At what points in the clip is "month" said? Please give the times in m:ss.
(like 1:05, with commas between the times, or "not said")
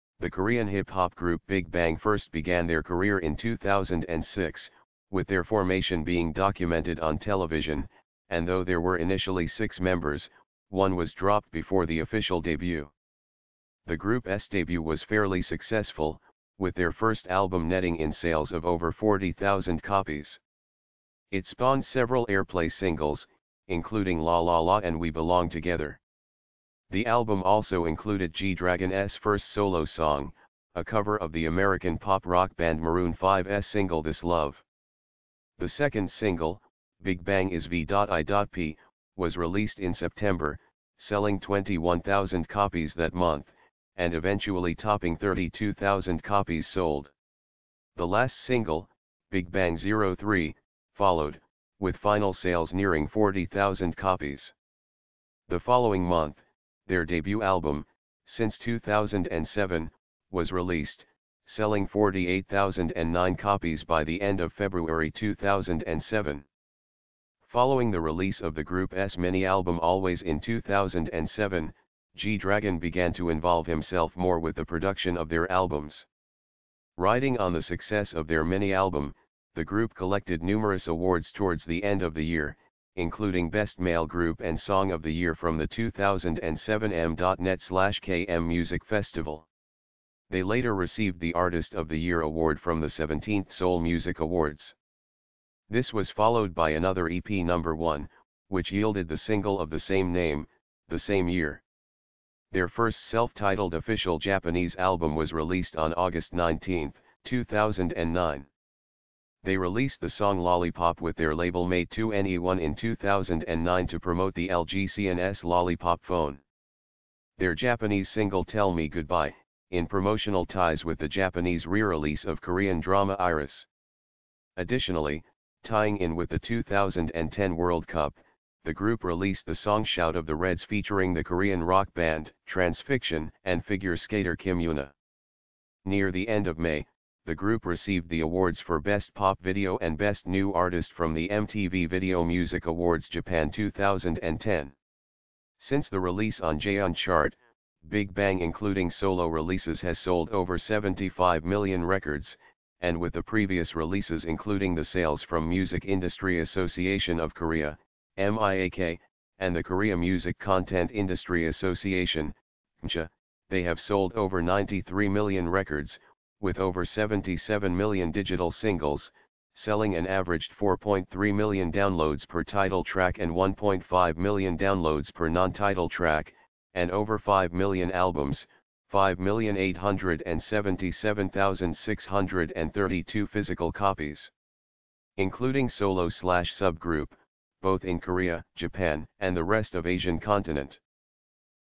0:43, 0:56.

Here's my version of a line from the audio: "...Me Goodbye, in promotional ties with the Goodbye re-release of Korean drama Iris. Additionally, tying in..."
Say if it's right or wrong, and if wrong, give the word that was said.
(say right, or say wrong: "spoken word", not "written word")
wrong: "Japanese", not "Goodbye".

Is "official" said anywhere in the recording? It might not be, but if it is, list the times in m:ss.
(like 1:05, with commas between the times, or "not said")
0:12, 1:43.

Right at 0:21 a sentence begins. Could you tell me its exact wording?
It spawned several airplay singles, including La La La and We Belong Together.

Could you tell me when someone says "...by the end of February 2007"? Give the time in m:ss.
1:03.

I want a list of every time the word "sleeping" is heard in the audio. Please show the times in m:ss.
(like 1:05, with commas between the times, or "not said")
not said.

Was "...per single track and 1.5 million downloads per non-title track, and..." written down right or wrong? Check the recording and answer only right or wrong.
wrong.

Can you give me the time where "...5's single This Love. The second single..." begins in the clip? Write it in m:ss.
0:33.